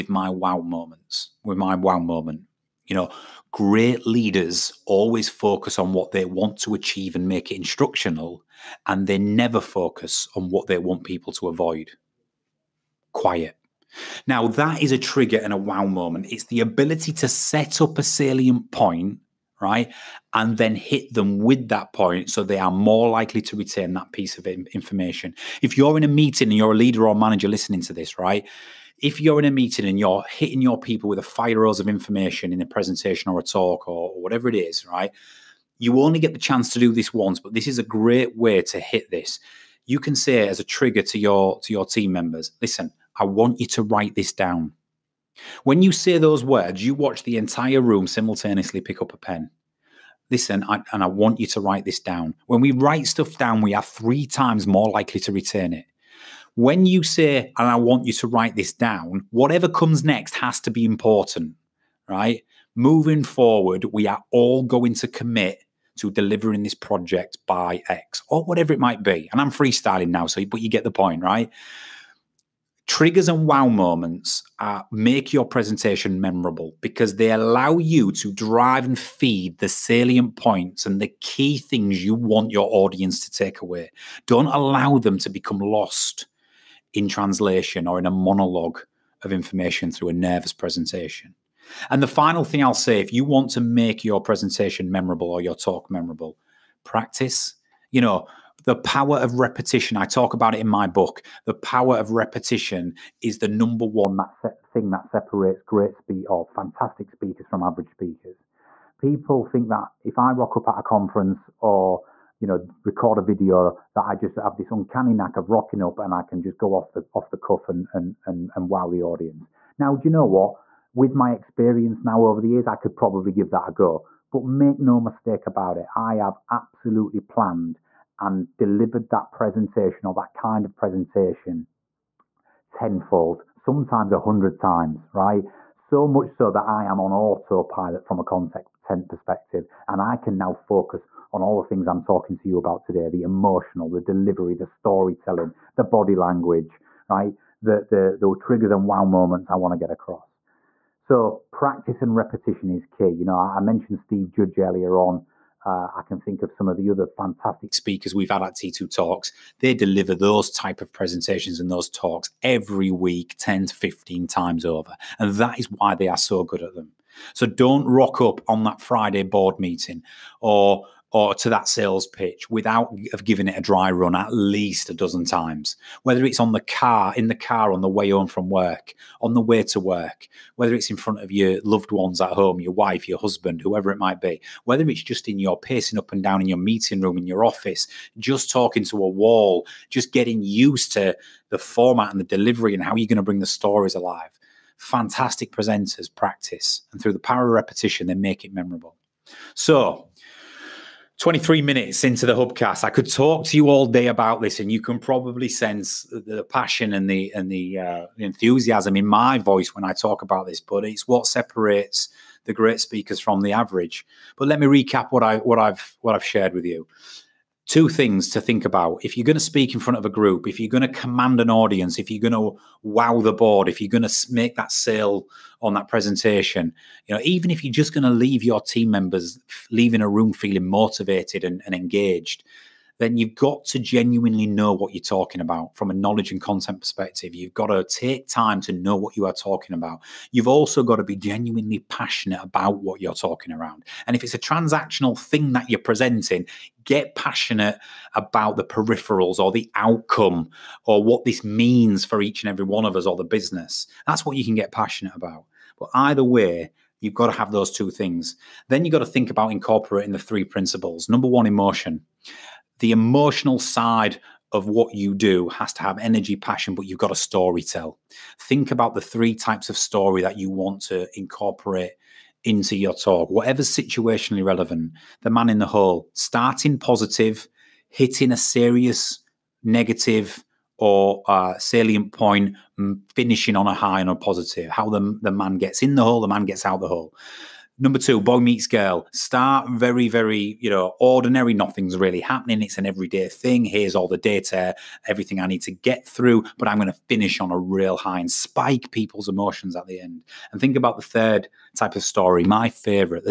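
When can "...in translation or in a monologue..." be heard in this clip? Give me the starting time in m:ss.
1:26.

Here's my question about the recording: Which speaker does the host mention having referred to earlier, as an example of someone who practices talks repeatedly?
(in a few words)
Steve Judge.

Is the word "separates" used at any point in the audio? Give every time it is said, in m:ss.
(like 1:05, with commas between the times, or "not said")
1:45, 3:31.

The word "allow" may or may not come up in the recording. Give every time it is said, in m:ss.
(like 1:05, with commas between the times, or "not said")
1:17, 1:24.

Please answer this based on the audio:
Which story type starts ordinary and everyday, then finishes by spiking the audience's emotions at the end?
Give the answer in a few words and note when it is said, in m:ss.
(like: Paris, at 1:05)
Boy meets girl, at 4:48.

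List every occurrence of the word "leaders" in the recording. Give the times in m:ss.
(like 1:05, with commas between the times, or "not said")
0:04, 0:26.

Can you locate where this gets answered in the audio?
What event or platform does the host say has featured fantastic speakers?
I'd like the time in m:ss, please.
2:38.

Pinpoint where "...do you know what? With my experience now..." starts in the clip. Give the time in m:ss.
1:59.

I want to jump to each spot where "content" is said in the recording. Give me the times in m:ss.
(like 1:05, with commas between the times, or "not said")
2:18, 3:56.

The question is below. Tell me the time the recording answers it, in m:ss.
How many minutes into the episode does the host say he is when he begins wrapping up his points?
3:21.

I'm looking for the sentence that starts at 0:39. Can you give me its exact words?
You can say as a trigger to your to your team members, listen, I want you to write this down.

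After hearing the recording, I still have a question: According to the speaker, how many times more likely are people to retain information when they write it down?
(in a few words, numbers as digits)
3 times.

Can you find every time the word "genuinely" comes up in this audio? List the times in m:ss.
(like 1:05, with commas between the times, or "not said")
3:53, 4:01.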